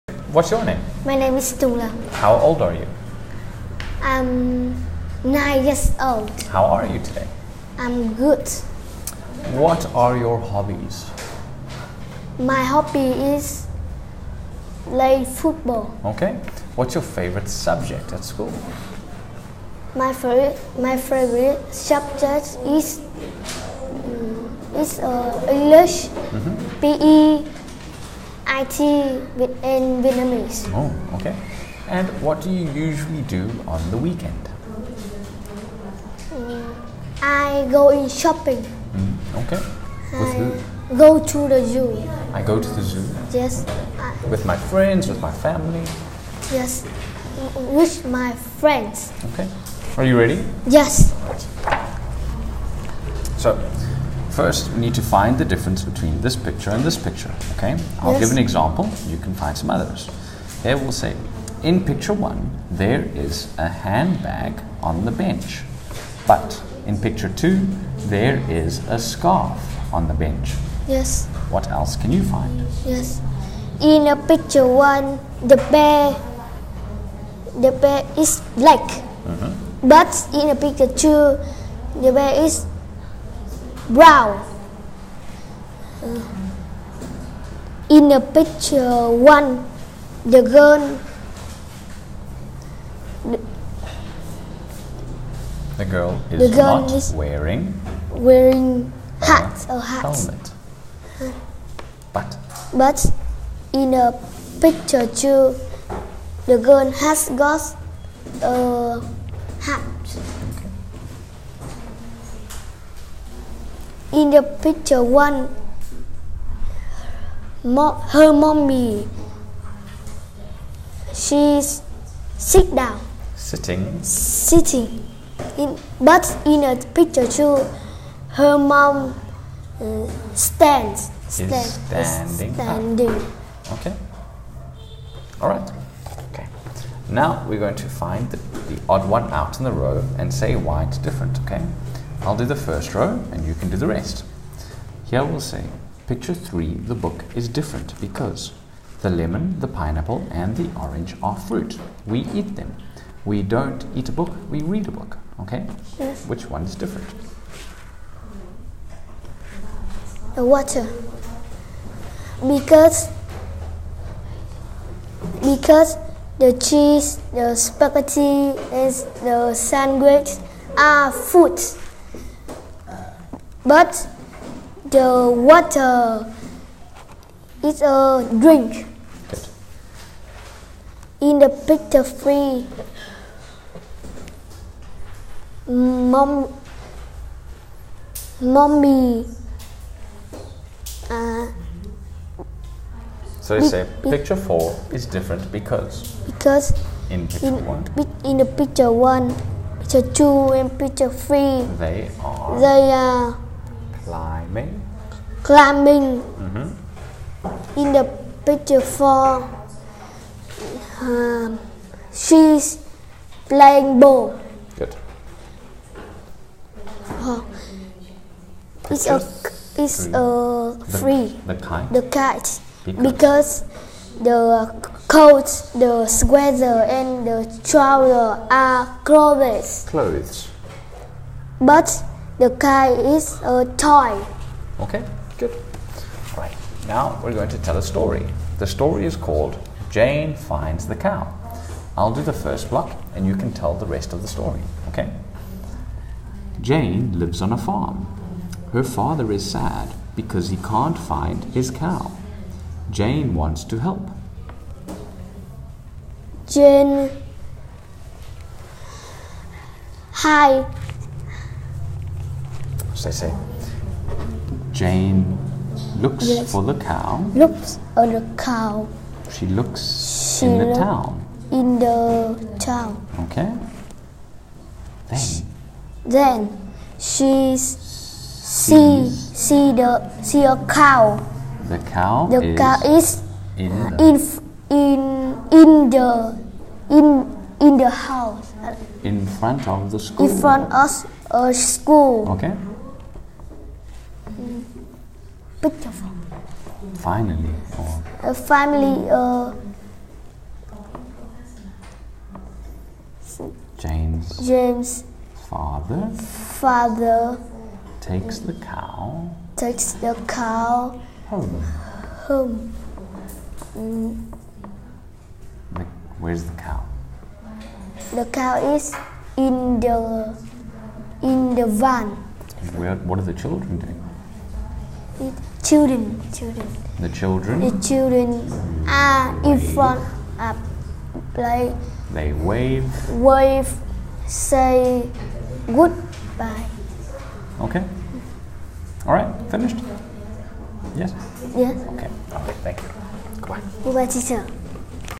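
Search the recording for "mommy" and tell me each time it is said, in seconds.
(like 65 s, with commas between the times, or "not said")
118 s, 188 s.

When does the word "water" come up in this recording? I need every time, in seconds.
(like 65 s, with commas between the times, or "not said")
160 s, 175 s.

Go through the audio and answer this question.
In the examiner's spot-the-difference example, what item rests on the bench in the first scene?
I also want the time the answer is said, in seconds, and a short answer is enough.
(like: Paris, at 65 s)
handbag, at 63 s.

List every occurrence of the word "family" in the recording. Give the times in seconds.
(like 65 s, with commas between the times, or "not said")
45 s, 298 s.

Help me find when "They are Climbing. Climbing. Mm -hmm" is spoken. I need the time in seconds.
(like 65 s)
202 s.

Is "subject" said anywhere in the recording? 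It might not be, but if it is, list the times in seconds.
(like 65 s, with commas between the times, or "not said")
17 s, 21 s.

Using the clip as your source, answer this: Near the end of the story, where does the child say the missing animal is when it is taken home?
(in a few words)
in the van.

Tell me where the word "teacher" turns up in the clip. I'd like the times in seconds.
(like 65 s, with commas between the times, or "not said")
344 s.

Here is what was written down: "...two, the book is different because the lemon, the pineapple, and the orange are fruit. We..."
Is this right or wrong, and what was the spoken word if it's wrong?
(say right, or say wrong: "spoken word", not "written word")
wrong: "three", not "two".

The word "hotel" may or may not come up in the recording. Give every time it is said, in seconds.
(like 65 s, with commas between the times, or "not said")
not said.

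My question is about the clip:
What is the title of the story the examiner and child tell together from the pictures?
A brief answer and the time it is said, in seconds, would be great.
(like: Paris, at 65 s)
Jane Finds the Cow, at 239 s.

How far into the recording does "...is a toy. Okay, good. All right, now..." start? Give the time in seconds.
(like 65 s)
233 s.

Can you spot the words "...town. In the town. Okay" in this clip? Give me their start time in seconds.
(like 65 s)
270 s.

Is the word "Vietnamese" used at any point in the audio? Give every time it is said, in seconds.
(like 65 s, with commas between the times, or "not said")
30 s.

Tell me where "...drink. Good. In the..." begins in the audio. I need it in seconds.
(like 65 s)
178 s.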